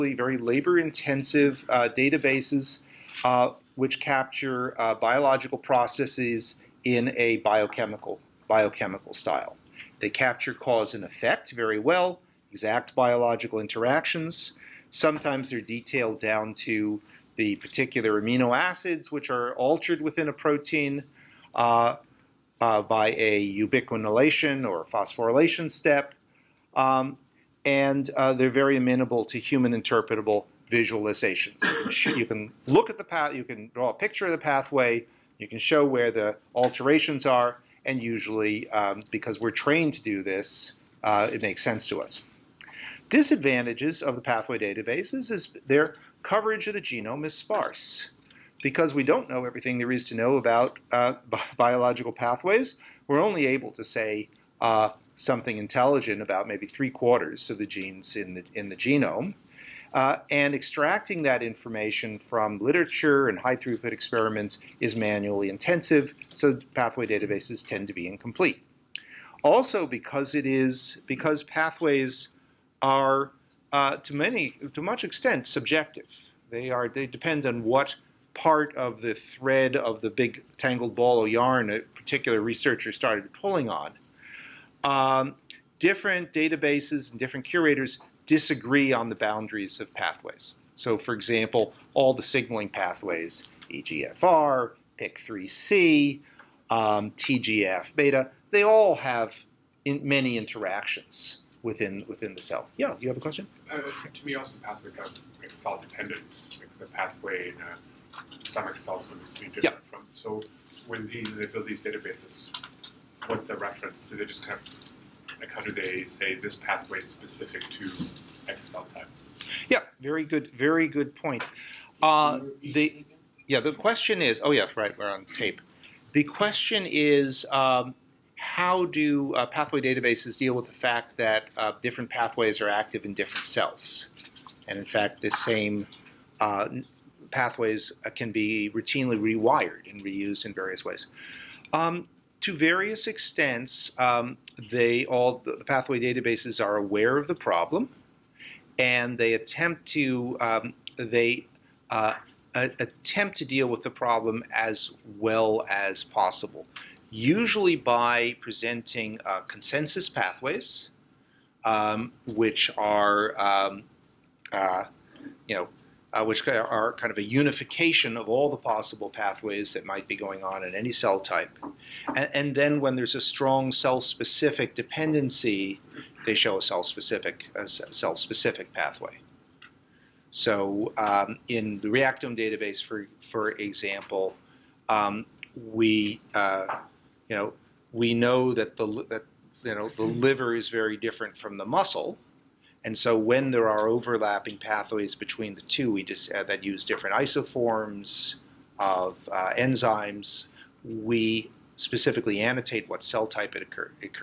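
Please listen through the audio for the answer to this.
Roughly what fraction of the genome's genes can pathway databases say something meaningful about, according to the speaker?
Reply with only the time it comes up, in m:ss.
0:56.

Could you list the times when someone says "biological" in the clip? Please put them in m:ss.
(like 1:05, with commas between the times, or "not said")
0:04, 0:12, 0:51.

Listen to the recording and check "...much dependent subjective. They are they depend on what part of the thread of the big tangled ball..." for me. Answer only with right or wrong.
wrong.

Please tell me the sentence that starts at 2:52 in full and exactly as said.
And, and then when there's a strong cell-specific dependency, they show a cell-specific cell-specific pathway.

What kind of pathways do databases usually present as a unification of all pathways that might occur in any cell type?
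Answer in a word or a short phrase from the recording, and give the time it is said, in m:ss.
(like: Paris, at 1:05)
consensus pathways, at 2:39.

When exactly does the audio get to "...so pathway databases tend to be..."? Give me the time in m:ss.
1:06.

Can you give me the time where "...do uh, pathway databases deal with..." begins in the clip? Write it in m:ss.
2:08.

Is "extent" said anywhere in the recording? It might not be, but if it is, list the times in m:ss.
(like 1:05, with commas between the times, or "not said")
1:15, 2:23.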